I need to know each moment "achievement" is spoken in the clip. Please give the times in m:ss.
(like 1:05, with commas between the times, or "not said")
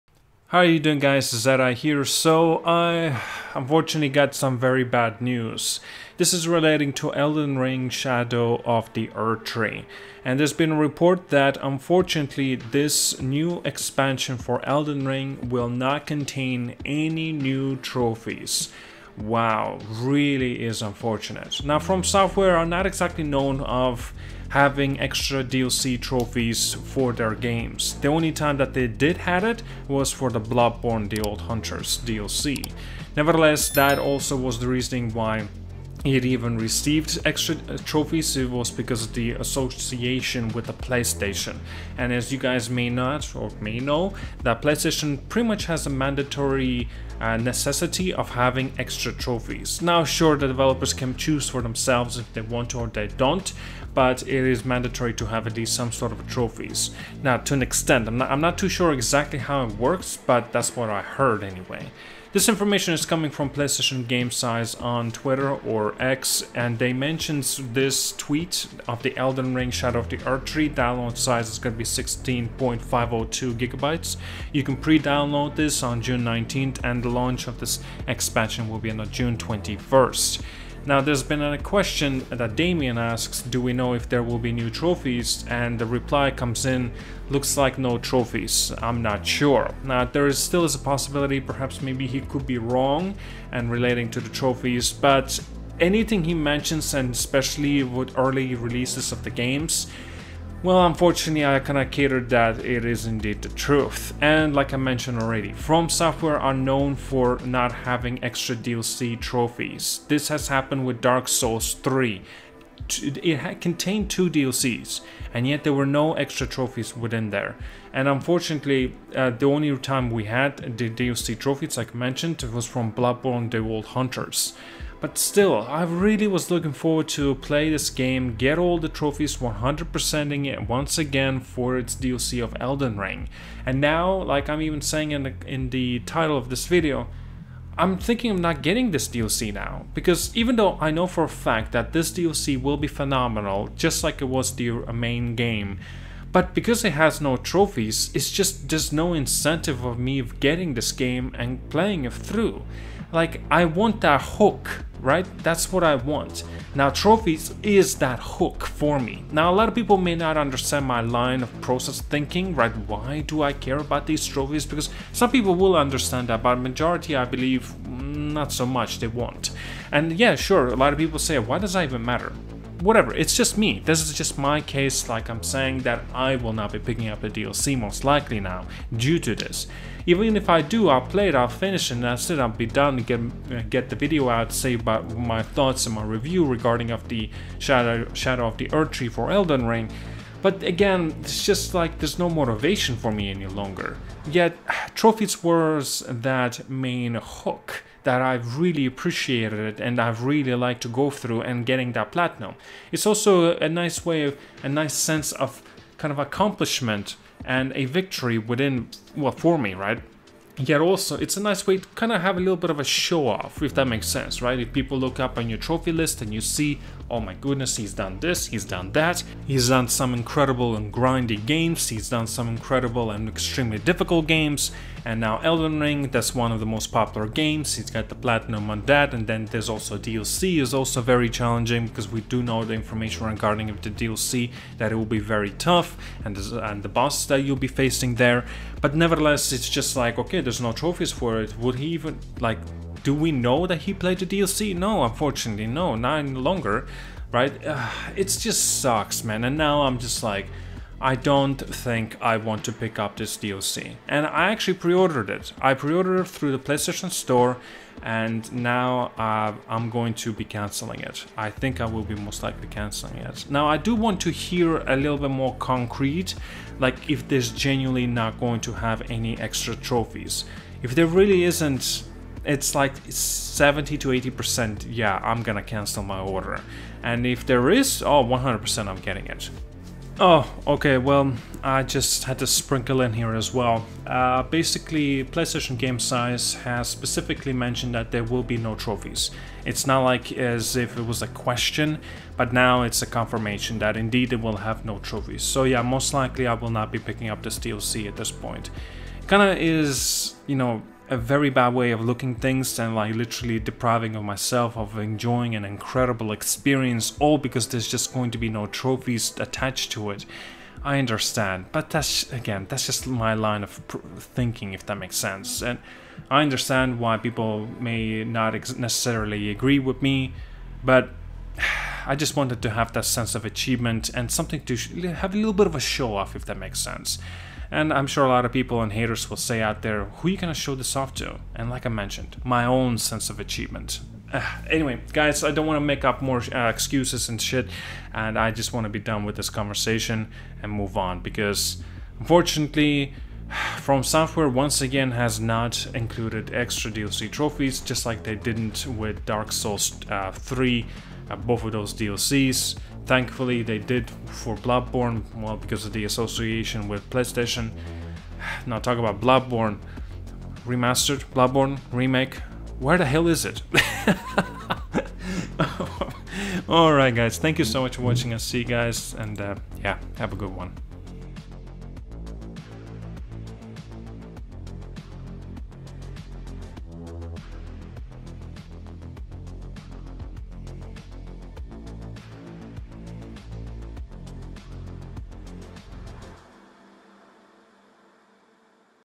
5:23, 5:33.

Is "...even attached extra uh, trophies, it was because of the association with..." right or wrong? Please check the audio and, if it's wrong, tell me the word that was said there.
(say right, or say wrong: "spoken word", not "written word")
wrong: "received", not "attached".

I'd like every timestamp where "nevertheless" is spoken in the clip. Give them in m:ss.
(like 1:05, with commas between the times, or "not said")
0:33, 3:58.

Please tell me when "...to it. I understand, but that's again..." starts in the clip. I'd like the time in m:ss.
5:09.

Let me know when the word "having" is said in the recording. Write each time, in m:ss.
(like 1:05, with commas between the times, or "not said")
0:24, 0:48, 1:47.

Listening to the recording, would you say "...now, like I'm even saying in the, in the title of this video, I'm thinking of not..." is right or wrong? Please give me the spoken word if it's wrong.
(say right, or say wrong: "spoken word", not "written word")
right.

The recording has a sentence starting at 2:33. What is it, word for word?
Like, I want that hook right?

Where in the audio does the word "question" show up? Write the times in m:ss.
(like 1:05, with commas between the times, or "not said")
1:21, 4:51.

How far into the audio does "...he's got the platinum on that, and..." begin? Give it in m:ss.
3:47.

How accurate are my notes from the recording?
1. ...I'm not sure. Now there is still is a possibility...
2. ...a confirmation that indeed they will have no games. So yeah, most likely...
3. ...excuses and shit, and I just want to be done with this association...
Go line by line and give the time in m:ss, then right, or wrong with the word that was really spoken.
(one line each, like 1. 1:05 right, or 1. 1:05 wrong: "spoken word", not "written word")
1. 1:28 right
2. 4:53 wrong: "trophies", not "games"
3. 5:36 wrong: "conversation", not "association".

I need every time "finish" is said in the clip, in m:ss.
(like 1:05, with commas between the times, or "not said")
3:01.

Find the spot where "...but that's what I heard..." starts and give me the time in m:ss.
1:00.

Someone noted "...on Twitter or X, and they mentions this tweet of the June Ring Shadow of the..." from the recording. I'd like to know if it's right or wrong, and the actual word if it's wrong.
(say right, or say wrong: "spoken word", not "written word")
wrong: "Elden", not "June".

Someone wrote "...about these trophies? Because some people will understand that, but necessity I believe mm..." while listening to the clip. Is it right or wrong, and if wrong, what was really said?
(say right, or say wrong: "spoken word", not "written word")
wrong: "majority", not "necessity".